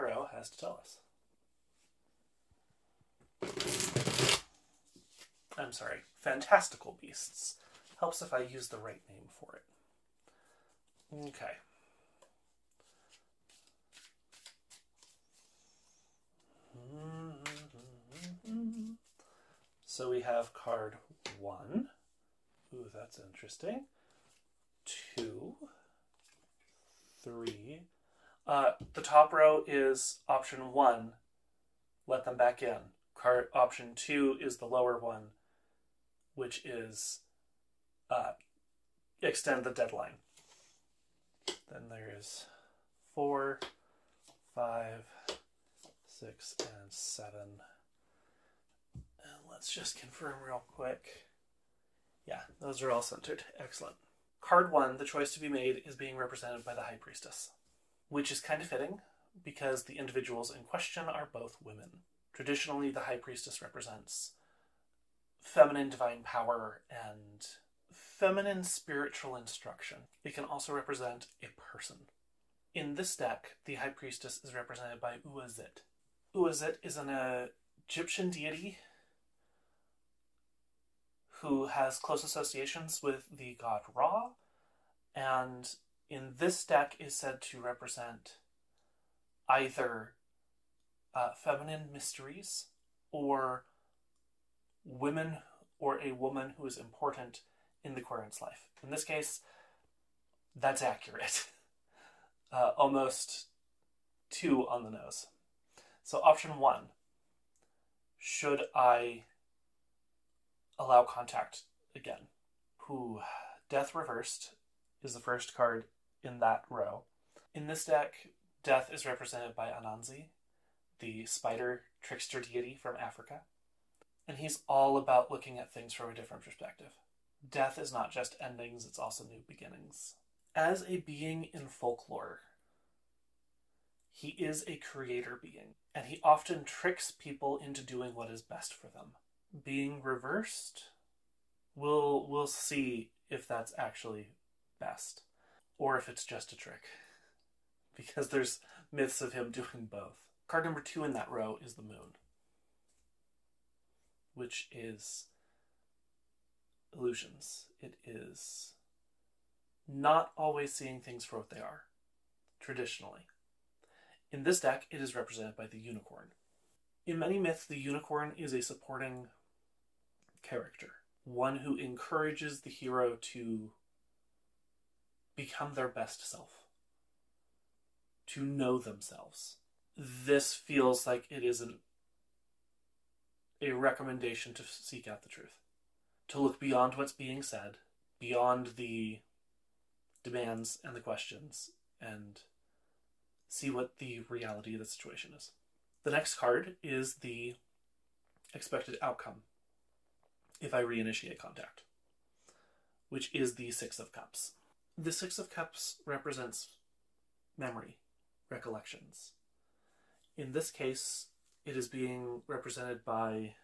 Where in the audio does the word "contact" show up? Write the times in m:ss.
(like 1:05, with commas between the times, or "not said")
1:51, 3:21.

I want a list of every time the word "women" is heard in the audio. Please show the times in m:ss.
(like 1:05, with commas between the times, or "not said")
1:01, 1:34.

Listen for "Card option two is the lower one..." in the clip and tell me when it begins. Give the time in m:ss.
0:33.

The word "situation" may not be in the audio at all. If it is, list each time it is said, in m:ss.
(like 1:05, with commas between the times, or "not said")
3:14.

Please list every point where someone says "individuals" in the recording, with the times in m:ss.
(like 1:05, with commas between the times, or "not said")
0:59.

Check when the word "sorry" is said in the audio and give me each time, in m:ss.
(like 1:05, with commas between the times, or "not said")
0:05.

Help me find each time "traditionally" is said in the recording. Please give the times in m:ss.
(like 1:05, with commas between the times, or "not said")
1:02, 2:42.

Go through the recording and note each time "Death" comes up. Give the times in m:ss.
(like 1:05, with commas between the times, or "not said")
1:53, 1:58, 2:07.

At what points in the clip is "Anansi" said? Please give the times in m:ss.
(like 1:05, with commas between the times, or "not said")
1:59.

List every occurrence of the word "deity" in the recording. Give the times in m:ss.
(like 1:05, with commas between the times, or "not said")
1:18, 2:02.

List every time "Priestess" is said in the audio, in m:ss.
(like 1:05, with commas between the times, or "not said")
0:56, 1:03, 1:13.